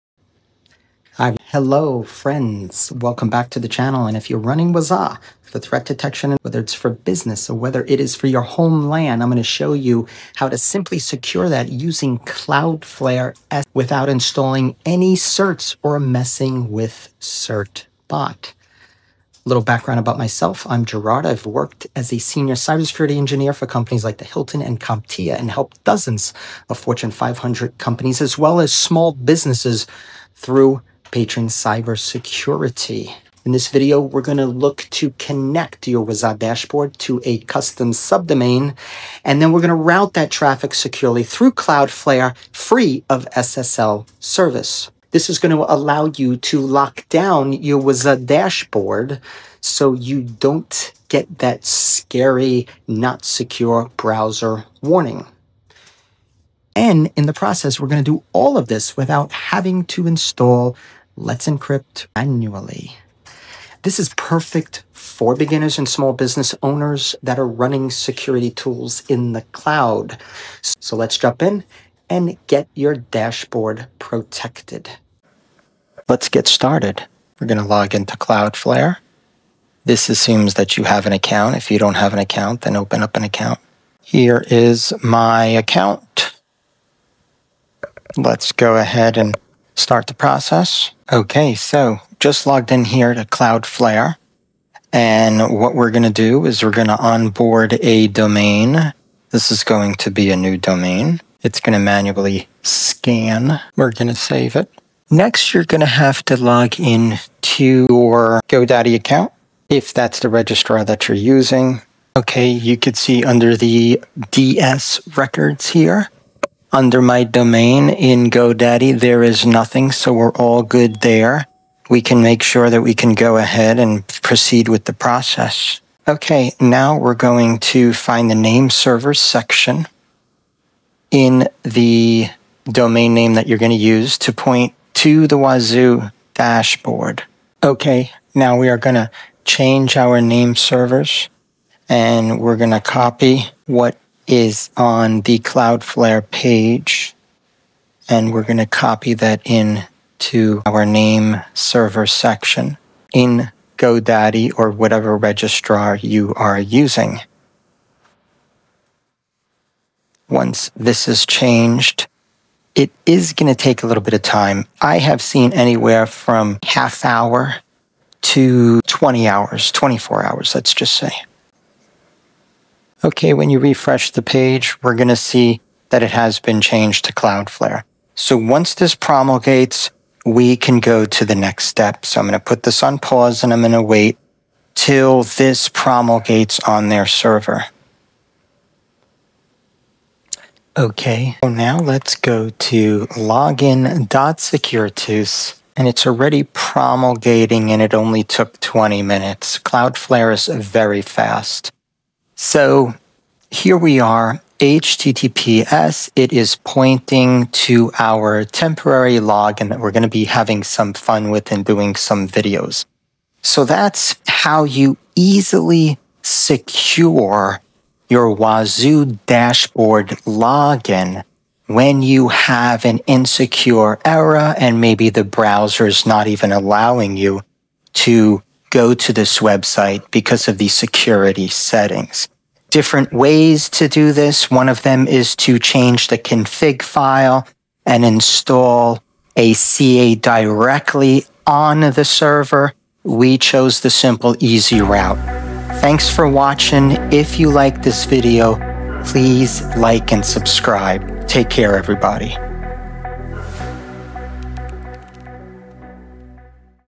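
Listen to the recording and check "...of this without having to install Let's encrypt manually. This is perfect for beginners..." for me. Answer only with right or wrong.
right.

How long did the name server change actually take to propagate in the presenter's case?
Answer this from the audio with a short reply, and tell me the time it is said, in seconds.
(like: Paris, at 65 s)
20 minutes, at 198 s.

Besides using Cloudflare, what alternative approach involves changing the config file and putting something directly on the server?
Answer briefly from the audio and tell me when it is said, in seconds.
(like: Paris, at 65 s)
Install a CA, at 238 s.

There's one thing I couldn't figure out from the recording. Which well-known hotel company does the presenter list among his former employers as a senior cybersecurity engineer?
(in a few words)
Hilton.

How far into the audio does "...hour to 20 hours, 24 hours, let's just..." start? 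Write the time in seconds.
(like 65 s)
167 s.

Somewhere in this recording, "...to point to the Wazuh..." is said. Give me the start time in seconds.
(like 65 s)
134 s.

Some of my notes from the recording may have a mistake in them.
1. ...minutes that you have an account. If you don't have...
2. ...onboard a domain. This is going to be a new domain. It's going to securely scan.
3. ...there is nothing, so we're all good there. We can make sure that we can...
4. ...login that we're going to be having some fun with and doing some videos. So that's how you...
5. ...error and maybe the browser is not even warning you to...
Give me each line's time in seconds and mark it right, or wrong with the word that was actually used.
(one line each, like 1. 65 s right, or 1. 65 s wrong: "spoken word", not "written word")
1. 80 s wrong: "assumes", not "minutes"
2. 96 s wrong: "manually", not "securely"
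3. 118 s right
4. 209 s right
5. 224 s wrong: "allowing", not "warning".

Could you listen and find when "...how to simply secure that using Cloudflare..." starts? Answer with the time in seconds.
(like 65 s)
10 s.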